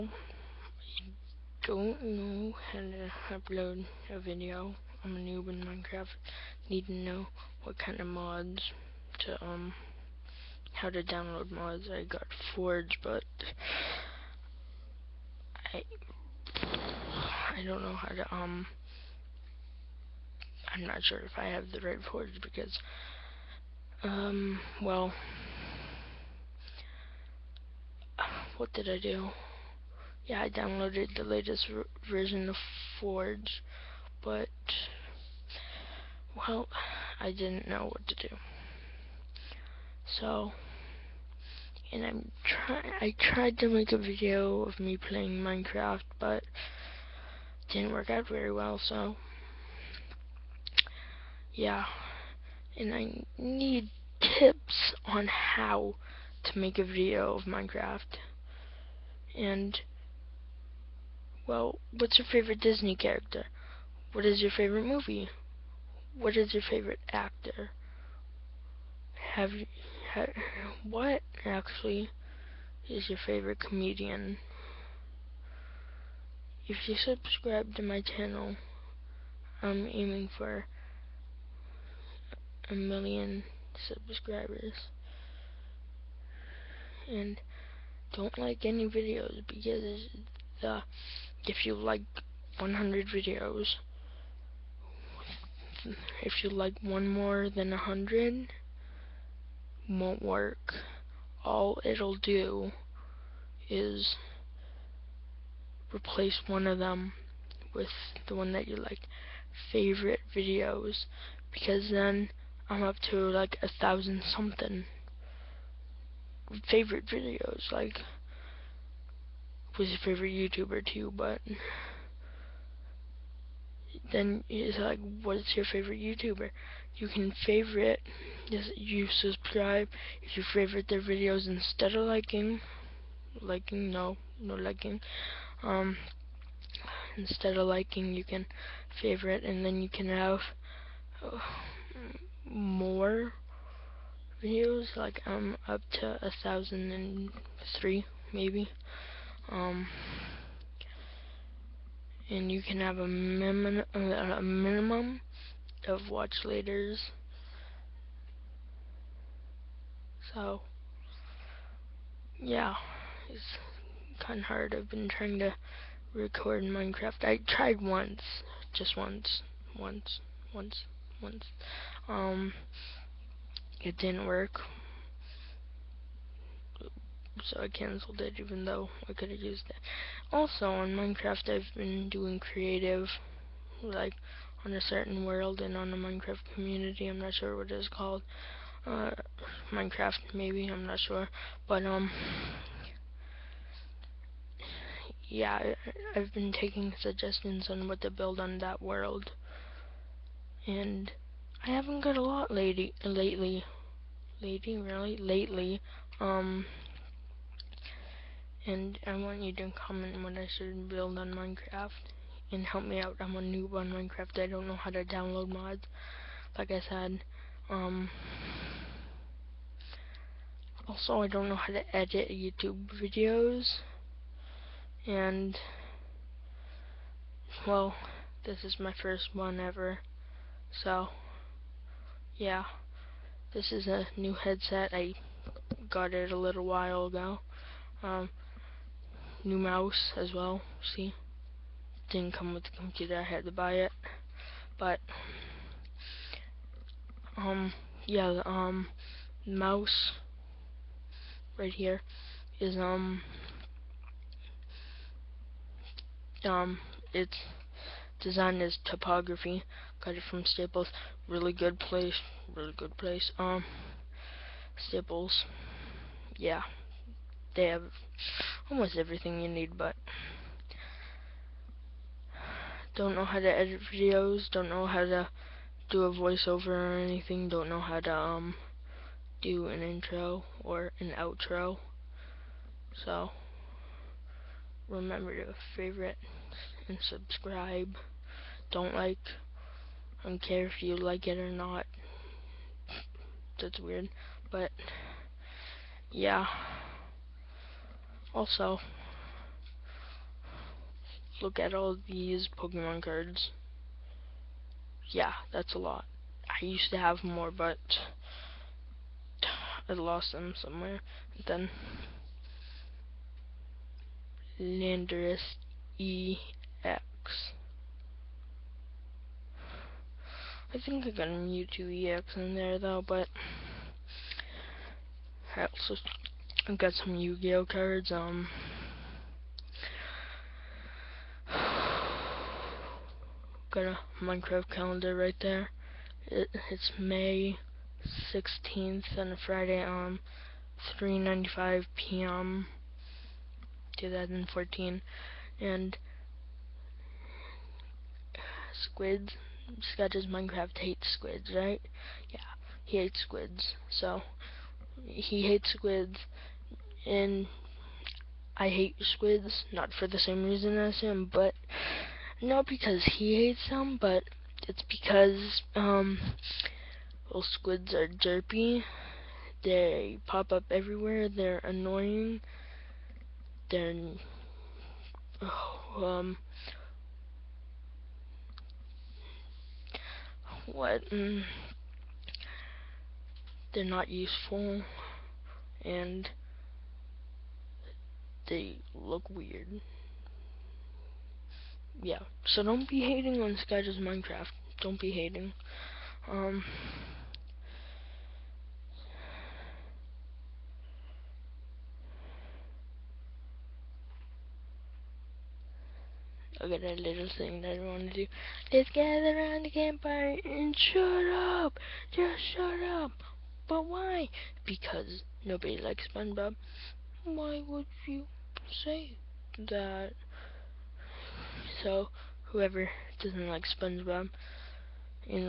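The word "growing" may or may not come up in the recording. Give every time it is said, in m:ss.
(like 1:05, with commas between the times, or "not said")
not said.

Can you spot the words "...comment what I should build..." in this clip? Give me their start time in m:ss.
3:29.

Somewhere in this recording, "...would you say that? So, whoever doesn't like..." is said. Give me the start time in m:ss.
6:57.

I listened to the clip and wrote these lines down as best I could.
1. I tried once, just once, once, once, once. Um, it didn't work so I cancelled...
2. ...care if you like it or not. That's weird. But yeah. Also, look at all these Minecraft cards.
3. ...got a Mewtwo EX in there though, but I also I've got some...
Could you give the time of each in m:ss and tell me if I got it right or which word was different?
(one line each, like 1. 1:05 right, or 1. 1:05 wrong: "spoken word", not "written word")
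1. 2:47 right
2. 4:50 wrong: "Pokemon", not "Minecraft"
3. 5:21 right.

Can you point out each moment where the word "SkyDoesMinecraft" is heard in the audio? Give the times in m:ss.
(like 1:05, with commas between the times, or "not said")
5:49, 6:33.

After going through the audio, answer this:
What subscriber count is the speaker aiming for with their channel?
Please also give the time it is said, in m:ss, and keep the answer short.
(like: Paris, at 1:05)
a million, at 1:22.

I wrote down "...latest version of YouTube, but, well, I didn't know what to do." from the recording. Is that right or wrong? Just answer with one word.
wrong.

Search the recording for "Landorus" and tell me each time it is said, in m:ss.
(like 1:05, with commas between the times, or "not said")
5:14.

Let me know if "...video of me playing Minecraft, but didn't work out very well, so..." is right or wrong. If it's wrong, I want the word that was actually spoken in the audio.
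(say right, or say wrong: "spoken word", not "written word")
right.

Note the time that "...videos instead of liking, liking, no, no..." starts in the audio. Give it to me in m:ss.
2:11.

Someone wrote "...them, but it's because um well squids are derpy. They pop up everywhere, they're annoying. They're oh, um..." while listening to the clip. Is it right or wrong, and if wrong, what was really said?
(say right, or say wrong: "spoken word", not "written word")
right.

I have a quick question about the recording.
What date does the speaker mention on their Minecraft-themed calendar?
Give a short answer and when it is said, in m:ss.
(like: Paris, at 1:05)
May 16, at 5:36.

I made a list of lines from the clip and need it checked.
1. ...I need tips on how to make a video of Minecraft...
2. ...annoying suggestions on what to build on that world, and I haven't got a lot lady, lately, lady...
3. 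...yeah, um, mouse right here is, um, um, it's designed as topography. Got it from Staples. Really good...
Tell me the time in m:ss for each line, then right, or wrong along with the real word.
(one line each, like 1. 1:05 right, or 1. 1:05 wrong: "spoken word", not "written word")
1. 0:52 right
2. 3:16 wrong: "taking", not "annoying"
3. 4:08 right.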